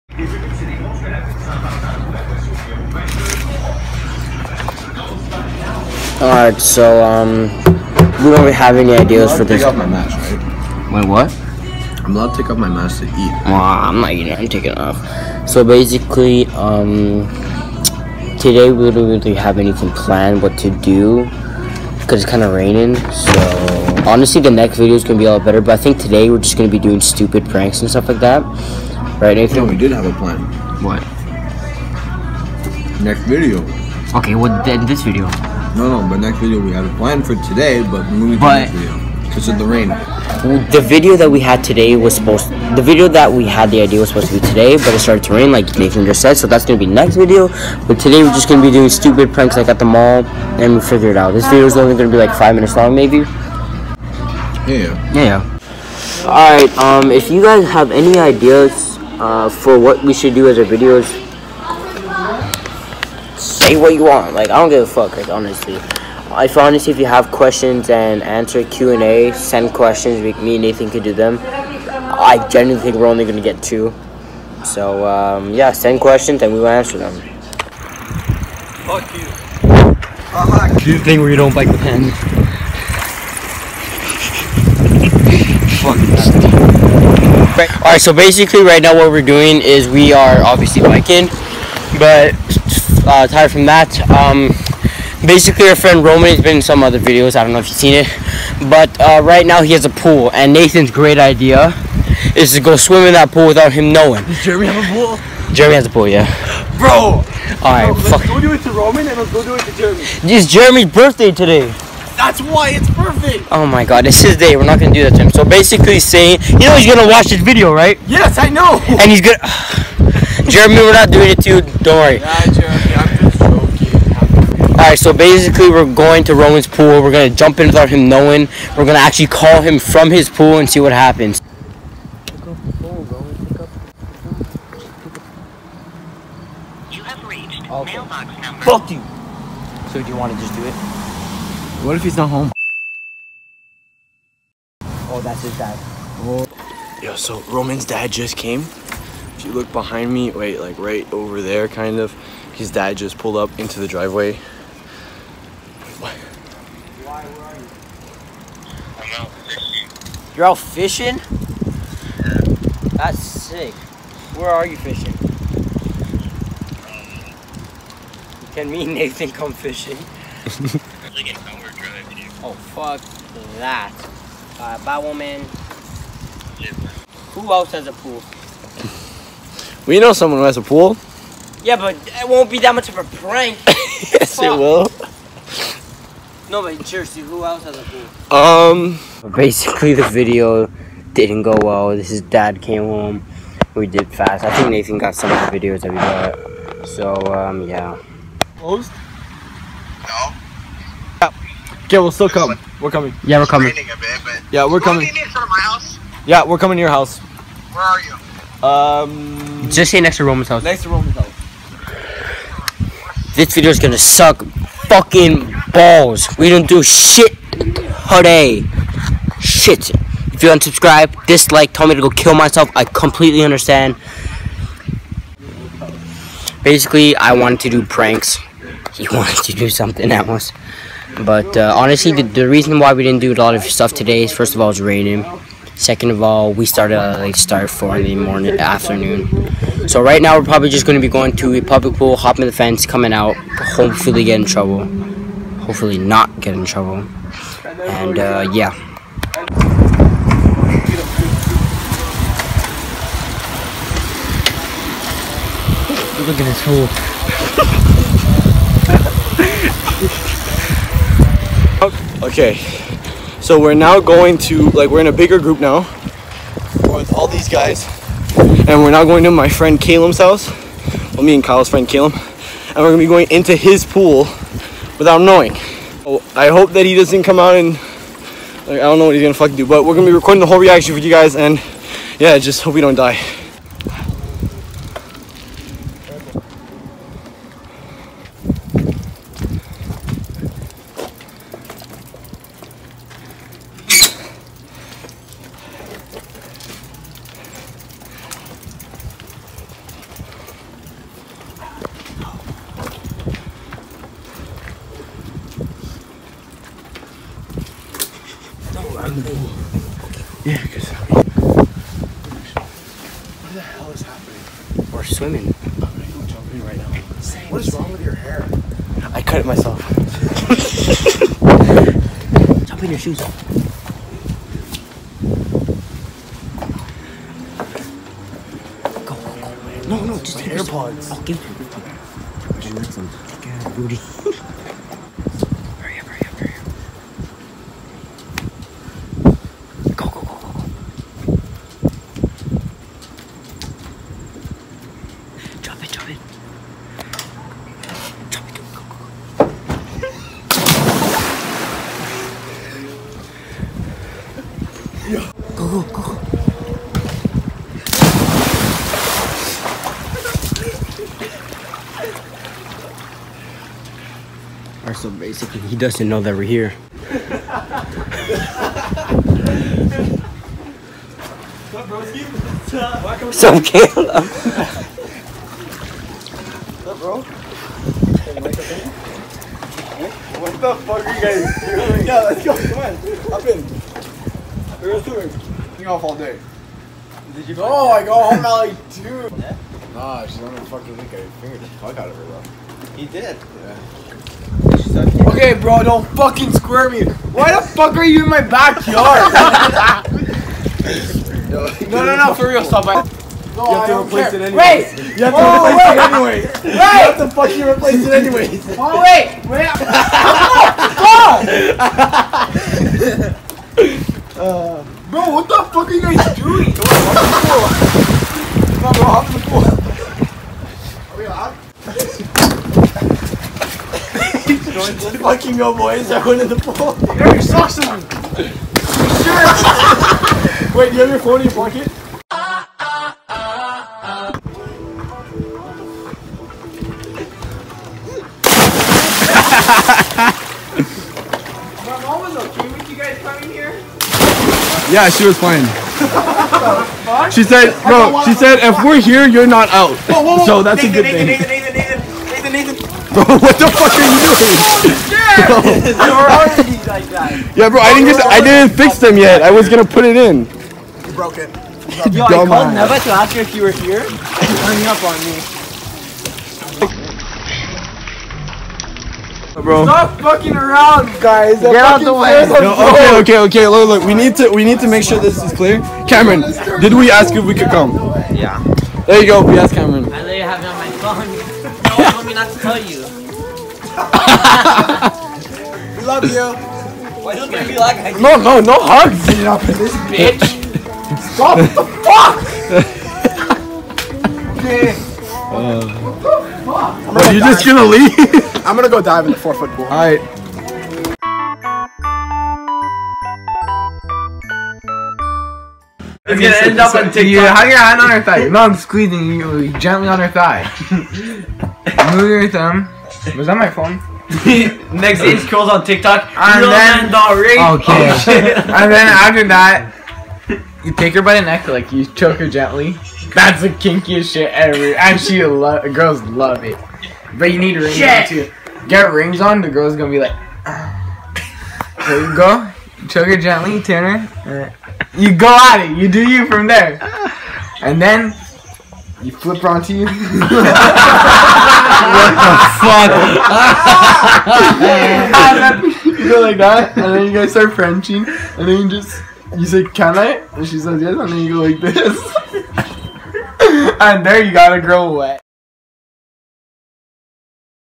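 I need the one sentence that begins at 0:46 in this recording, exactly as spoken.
So that's gonna be next video.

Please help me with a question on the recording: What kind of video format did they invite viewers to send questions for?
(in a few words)
Q and A.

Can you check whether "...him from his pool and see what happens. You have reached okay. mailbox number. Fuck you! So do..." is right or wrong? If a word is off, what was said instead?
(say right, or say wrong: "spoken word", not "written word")
right.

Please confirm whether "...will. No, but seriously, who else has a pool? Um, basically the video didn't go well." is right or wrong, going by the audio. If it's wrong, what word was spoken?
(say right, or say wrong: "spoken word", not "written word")
right.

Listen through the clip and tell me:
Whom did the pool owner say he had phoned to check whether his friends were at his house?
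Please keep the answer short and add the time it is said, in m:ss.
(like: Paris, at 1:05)
Neva, at 7:42.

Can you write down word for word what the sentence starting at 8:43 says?
That's the kinkiest shit ever, and she love girls love it.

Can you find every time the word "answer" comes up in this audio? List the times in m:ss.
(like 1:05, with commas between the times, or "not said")
1:08, 1:16.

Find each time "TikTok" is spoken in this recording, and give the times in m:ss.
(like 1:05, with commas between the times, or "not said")
8:27, 8:35.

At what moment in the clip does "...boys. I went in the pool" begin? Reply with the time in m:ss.
7:05.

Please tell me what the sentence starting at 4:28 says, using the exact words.
And we're now going to my friend Kalem's house.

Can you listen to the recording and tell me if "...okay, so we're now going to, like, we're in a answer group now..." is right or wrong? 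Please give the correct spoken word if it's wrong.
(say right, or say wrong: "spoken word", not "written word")
wrong: "bigger", not "answer".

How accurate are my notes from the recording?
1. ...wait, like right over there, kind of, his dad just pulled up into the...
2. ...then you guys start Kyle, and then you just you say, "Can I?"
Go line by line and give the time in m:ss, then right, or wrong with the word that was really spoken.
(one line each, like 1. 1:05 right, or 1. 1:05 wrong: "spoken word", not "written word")
1. 2:30 right
2. 9:07 wrong: "Frenching", not "Kyle".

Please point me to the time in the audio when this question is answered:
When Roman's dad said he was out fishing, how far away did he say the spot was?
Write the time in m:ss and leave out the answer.
2:51.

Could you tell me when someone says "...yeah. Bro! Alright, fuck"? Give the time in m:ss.
1:46.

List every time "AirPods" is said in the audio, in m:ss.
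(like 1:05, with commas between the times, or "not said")
5:30.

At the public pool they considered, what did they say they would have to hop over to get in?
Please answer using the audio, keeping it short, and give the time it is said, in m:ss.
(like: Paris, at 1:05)
The fence, at 4:02.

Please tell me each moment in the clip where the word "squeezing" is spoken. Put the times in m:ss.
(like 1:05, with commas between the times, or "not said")
8:28.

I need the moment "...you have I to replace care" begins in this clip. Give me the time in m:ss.
6:43.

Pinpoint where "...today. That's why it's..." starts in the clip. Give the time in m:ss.
1:51.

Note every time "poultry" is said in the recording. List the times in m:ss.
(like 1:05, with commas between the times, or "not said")
not said.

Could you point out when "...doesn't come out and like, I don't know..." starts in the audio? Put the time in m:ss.
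4:36.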